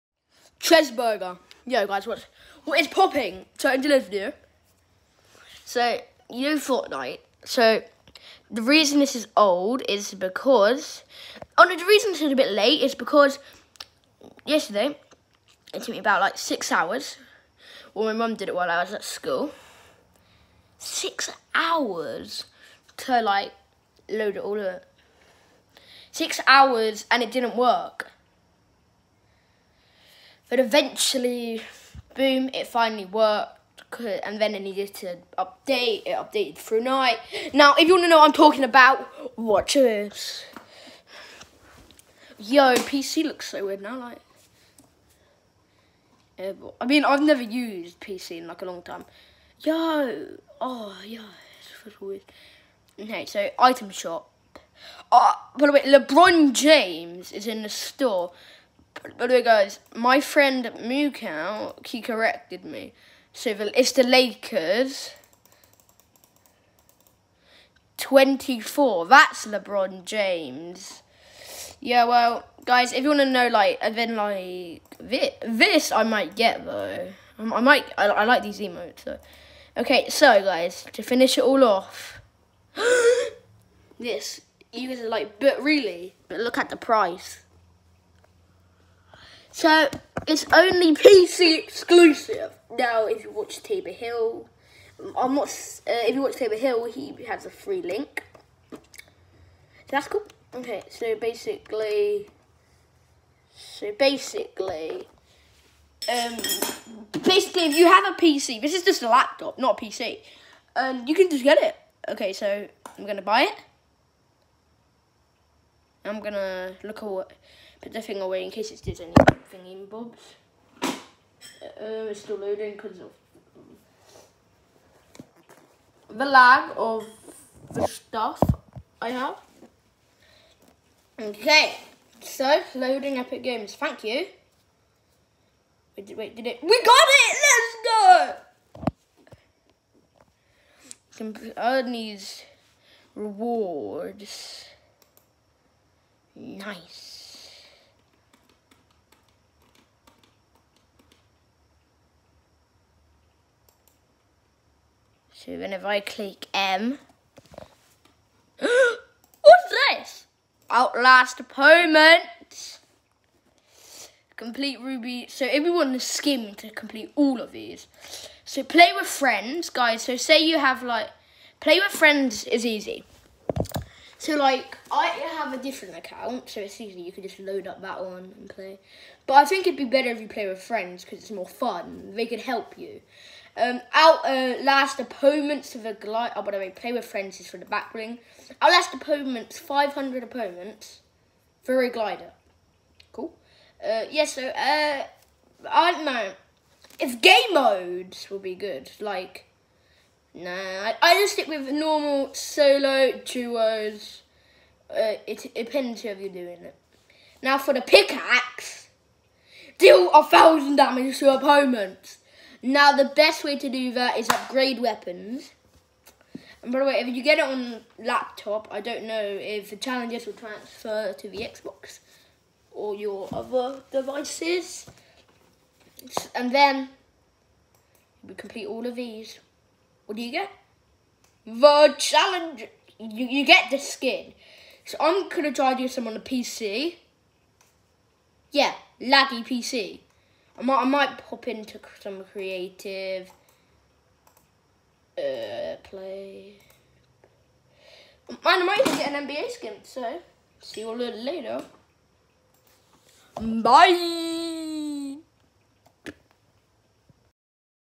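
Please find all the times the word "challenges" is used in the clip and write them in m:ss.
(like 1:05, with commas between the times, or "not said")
3:39, 3:51.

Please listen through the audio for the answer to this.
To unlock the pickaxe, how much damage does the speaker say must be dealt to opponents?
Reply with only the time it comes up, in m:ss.
3:30.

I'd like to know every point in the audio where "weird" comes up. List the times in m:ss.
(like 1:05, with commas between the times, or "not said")
0:43, 0:52.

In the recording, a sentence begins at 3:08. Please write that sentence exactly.
Our last opponents, 500 opponents for a glider.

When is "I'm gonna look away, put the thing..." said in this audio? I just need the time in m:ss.
1:56.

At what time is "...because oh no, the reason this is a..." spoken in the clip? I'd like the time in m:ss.
0:10.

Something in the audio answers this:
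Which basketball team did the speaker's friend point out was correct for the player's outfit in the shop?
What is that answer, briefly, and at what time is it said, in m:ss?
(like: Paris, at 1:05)
the Lakers, at 1:03.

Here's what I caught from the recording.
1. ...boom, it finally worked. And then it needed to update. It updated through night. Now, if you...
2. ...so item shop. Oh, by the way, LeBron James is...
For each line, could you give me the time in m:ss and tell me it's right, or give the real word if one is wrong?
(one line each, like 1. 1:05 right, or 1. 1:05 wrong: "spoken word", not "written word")
1. 0:32 right
2. 0:53 right.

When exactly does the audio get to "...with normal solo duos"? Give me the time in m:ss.
3:21.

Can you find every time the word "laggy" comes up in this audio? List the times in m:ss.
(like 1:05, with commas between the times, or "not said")
3:58.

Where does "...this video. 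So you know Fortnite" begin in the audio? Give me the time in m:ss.
0:03.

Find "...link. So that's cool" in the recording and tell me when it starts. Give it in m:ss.
1:37.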